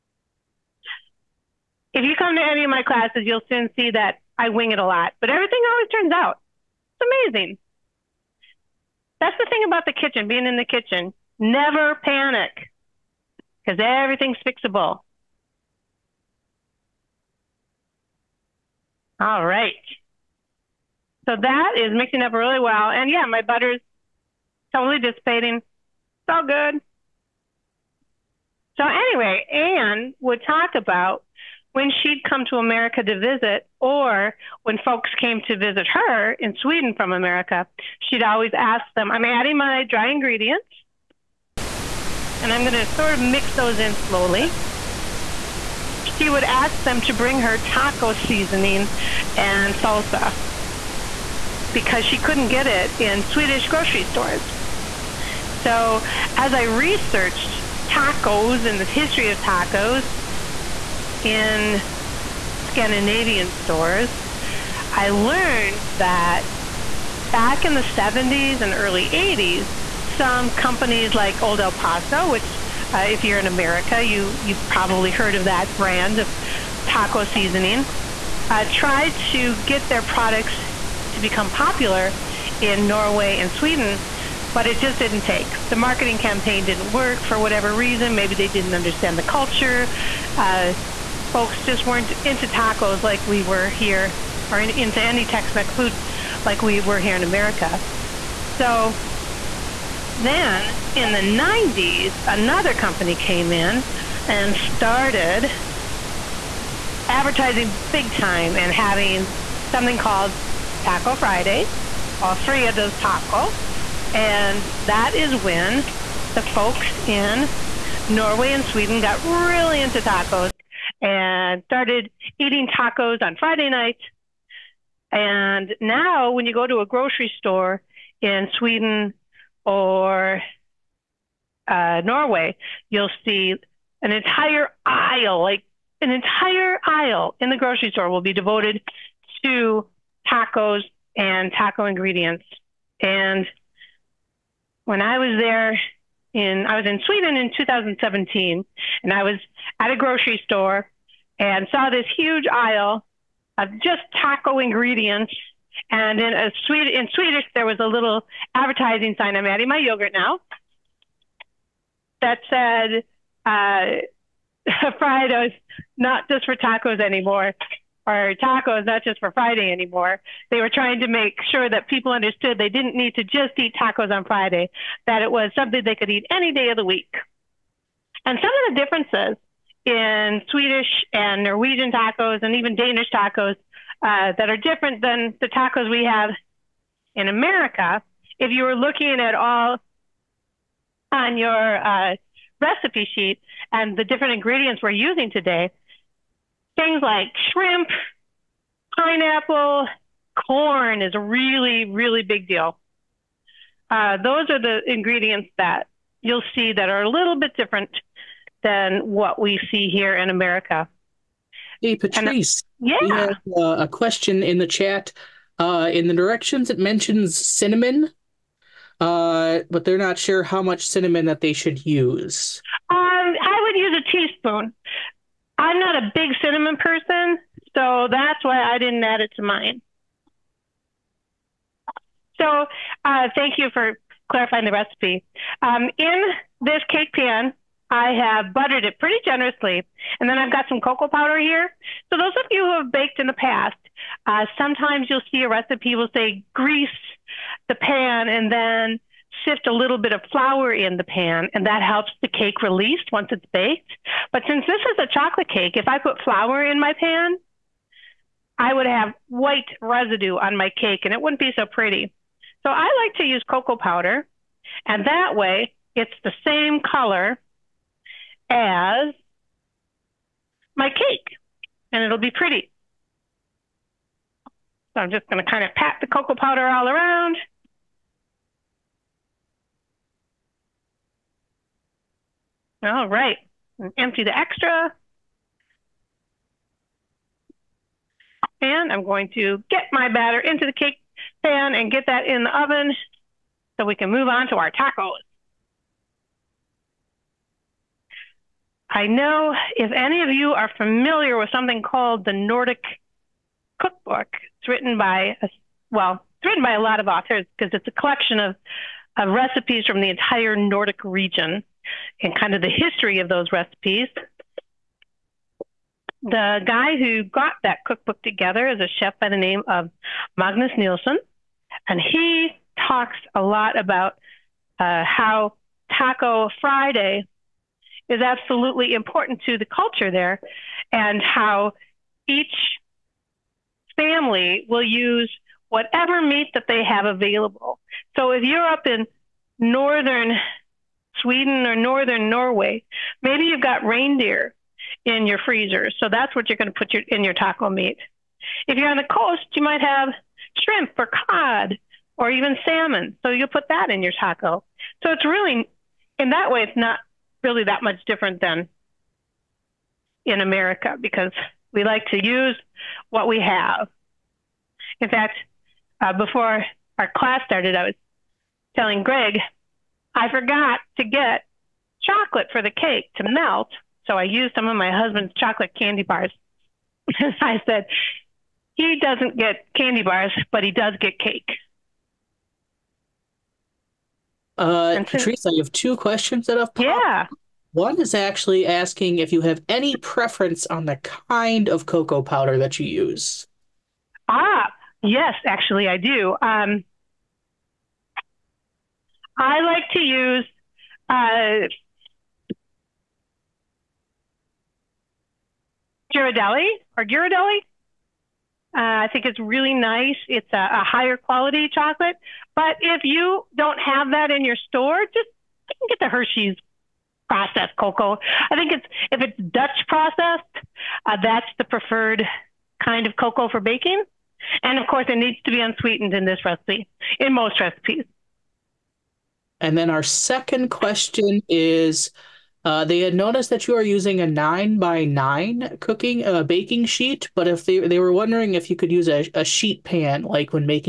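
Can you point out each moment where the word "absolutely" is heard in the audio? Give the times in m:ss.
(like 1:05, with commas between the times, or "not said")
5:28.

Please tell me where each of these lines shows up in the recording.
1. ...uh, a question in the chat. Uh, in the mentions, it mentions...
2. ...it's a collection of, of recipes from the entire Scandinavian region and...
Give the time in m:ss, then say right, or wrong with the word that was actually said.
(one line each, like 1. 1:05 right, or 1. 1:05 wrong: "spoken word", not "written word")
1. 3:33 wrong: "directions", not "mentions"
2. 5:07 wrong: "Nordic", not "Scandinavian".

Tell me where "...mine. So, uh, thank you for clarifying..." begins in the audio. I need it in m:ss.
3:49.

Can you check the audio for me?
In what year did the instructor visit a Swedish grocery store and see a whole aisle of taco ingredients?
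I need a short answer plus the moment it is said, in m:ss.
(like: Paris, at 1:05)
2017, at 2:27.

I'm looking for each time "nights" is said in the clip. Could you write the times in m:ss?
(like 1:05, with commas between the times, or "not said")
2:03.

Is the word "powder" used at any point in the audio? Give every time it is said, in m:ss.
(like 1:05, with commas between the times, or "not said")
4:01, 4:23, 4:36, 6:32.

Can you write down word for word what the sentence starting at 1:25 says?
The marketing campaign didn't work for whatever reason.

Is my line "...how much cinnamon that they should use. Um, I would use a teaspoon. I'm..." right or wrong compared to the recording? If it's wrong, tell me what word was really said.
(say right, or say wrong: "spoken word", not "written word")
right.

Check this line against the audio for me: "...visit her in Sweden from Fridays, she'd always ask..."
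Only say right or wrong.
wrong.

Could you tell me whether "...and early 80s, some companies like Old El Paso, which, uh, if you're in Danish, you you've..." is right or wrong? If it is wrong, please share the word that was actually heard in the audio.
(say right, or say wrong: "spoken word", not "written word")
wrong: "America", not "Danish".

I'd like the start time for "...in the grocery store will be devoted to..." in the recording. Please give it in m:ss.
2:17.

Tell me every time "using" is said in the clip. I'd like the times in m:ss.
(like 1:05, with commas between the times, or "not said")
3:14, 7:13.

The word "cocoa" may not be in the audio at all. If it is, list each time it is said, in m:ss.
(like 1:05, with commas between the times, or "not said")
4:00, 4:23, 4:36, 6:31, 6:57, 7:03.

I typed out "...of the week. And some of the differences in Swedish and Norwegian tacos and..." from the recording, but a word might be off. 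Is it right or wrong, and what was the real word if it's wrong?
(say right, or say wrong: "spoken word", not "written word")
right.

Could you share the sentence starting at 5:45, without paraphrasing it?
So that's what you're going to put your, in your taco meat.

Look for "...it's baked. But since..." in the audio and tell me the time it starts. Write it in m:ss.
4:13.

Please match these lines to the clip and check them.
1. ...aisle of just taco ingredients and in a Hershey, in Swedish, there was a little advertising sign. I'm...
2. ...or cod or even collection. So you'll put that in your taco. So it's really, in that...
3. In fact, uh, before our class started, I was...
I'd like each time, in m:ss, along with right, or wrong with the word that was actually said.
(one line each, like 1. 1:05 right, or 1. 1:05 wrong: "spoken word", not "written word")
1. 2:32 wrong: "Swedish", not "Hershey"
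2. 5:50 wrong: "salmon", not "collection"
3. 6:04 right.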